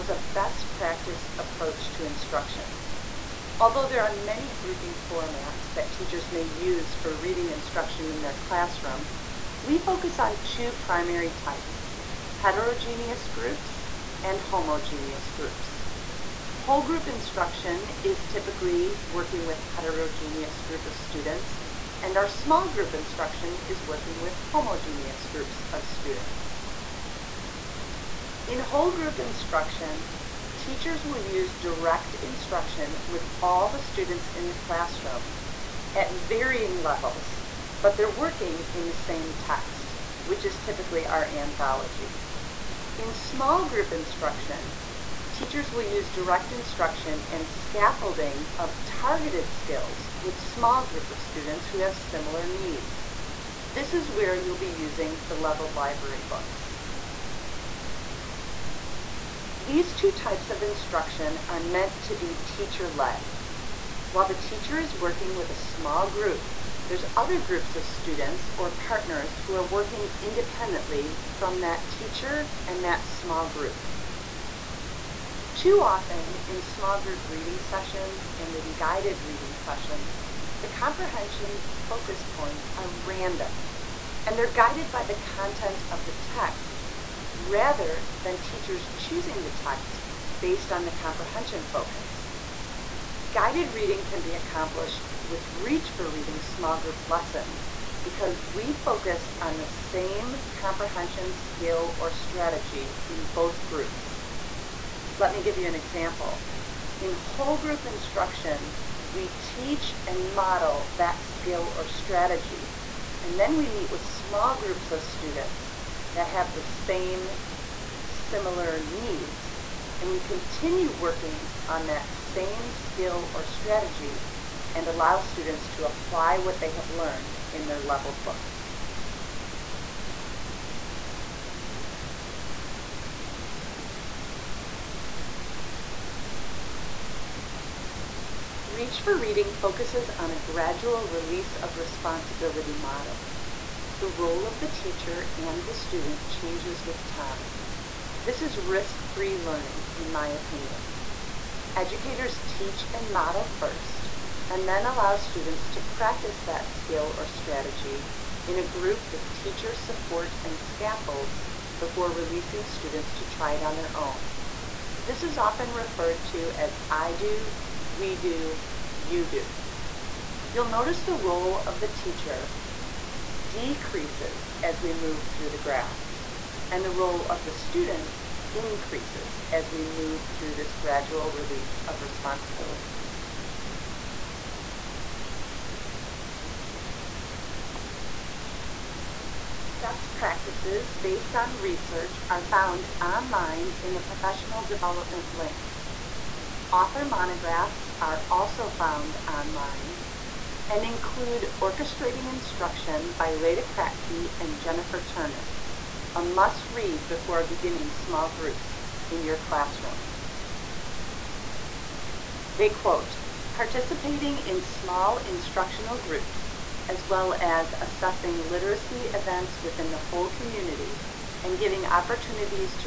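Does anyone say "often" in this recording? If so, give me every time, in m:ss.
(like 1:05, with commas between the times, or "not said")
1:15, 2:45.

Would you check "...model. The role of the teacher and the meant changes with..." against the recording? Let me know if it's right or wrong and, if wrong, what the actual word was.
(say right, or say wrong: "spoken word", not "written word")
wrong: "student", not "meant".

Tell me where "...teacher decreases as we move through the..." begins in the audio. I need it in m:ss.
2:51.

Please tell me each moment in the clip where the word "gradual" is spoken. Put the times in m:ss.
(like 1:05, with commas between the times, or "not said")
2:20, 3:00.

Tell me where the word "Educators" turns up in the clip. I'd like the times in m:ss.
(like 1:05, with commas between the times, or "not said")
2:31.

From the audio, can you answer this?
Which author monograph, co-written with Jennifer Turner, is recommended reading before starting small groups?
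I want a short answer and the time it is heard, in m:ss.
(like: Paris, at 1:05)
Orchestrating Instruction, at 3:21.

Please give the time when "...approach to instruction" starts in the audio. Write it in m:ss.
0:01.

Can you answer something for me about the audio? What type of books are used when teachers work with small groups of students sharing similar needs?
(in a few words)
leveled library books.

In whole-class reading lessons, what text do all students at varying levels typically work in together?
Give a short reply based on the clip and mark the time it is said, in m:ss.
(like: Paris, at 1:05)
anthology, at 0:41.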